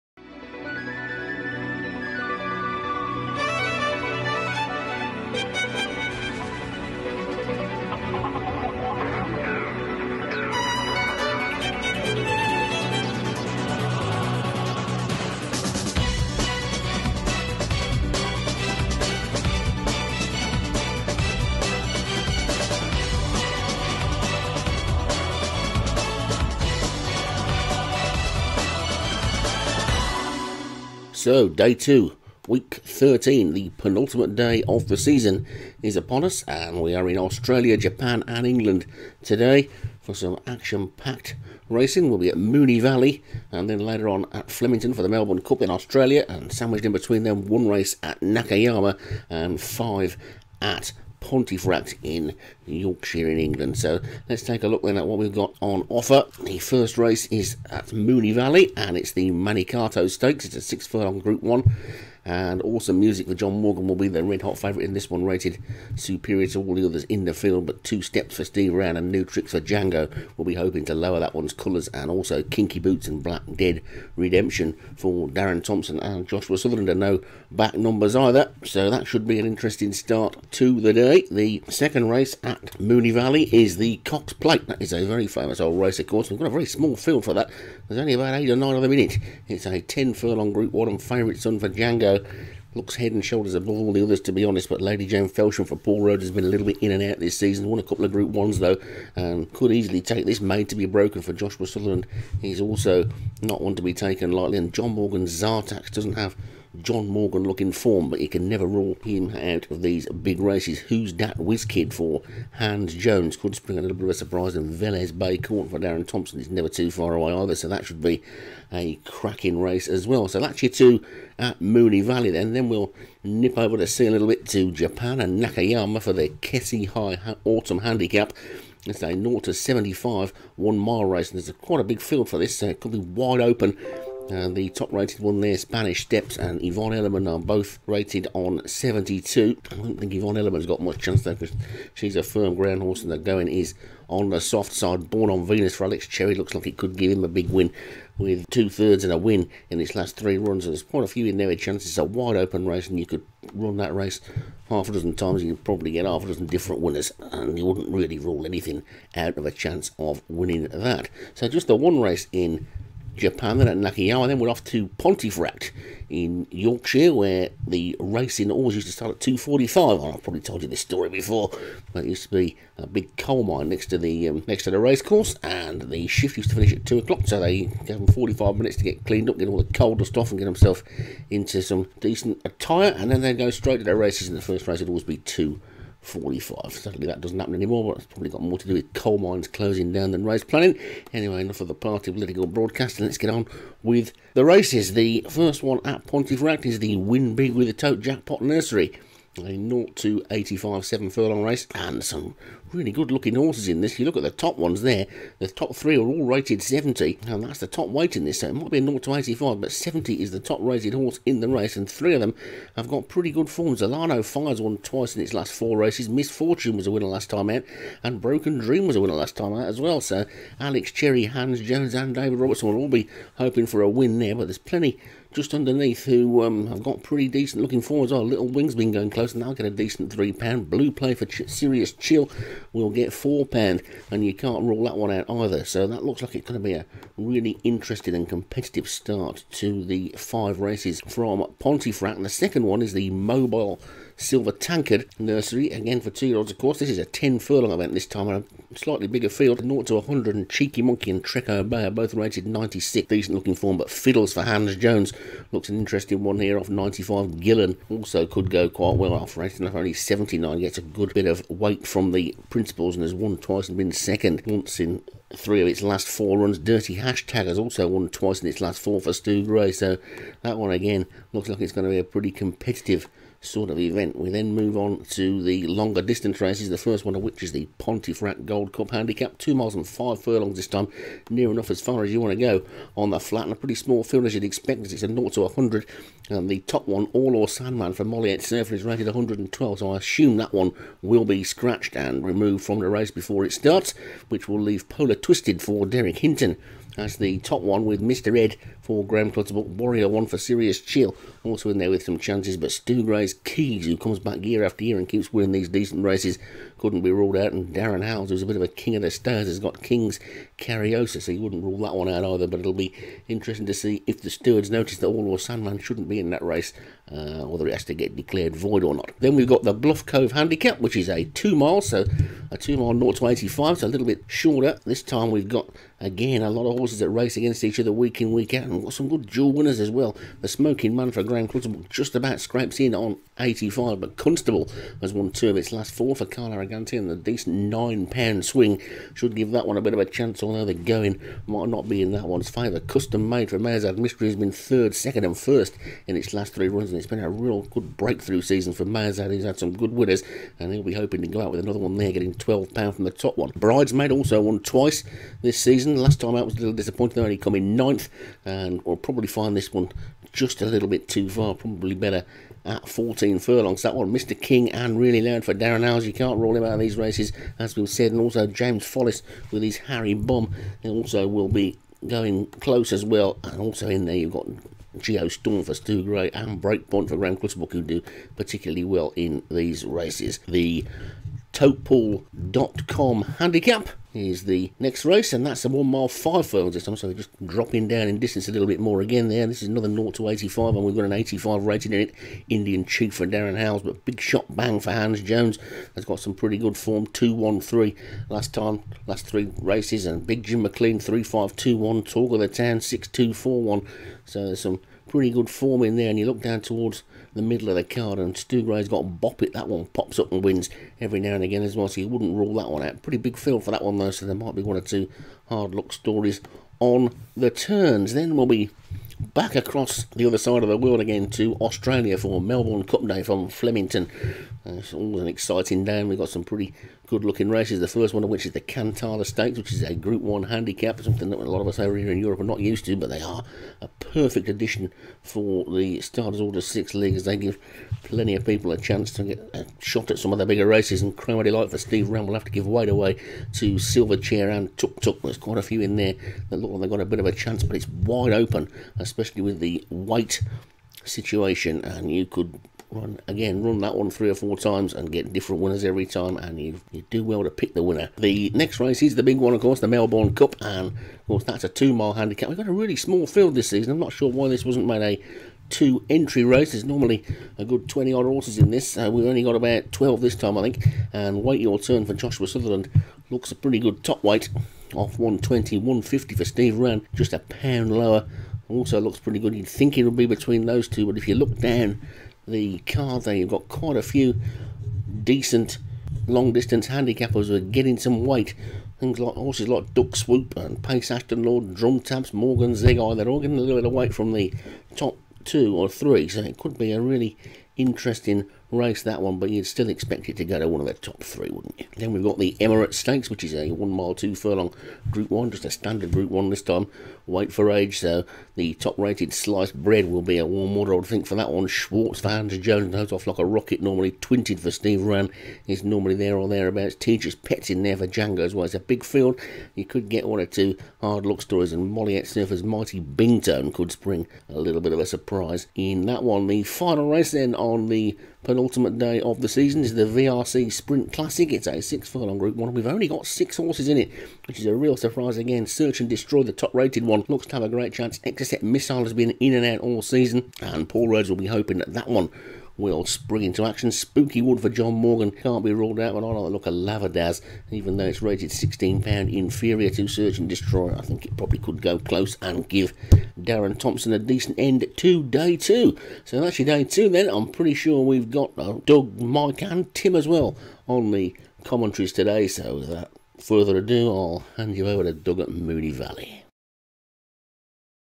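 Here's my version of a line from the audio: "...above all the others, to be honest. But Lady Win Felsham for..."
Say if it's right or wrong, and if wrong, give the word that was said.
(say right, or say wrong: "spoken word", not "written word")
wrong: "Jane", not "Win".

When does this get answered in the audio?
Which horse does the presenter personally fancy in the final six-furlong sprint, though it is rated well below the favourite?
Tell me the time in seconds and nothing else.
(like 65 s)
547 s.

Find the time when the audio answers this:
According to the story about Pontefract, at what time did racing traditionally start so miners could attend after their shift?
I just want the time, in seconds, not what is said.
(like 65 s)
169 s.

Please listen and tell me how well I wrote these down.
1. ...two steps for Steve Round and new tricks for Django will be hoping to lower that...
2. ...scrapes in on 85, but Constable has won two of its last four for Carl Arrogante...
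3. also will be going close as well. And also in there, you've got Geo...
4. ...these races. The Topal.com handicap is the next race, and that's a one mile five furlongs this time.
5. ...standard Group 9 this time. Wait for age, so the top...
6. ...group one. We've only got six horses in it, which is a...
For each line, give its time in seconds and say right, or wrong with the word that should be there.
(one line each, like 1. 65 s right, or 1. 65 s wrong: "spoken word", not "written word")
1. 67 s right
2. 332 s right
3. 370 s right
4. 379 s right
5. 505 s wrong: "1", not "9"
6. 532 s right.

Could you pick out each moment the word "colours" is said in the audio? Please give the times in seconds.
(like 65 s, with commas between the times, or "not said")
71 s.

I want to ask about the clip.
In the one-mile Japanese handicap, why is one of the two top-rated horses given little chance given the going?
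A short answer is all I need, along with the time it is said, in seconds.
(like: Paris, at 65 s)
Firm ground horse, at 142 s.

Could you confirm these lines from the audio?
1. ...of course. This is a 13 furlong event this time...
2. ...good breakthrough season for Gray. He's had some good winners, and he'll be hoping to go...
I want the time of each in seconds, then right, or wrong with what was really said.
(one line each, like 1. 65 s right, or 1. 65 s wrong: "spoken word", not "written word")
1. 246 s wrong: "10", not "13"
2. 347 s wrong: "Mazad", not "Gray".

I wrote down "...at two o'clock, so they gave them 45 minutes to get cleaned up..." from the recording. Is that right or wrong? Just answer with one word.
right.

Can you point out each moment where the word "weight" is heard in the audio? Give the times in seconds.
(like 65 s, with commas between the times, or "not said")
207 s, 261 s, 442 s, 449 s, 474 s, 488 s, 493 s.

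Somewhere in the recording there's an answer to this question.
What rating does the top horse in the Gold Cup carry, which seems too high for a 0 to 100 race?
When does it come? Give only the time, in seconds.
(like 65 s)
289 s.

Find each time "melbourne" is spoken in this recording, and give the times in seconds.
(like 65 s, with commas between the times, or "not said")
45 s, 422 s, 459 s.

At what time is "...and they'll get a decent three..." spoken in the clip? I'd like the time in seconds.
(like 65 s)
229 s.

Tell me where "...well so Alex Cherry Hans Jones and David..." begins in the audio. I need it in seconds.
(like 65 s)
219 s.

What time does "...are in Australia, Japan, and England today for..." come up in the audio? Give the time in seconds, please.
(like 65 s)
36 s.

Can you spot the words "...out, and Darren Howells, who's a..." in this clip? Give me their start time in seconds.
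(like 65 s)
307 s.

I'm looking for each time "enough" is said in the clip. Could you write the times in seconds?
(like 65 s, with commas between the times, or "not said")
191 s, 281 s.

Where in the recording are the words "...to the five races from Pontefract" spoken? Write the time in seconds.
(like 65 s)
239 s.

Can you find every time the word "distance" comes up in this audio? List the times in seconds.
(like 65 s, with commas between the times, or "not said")
276 s, 388 s, 486 s.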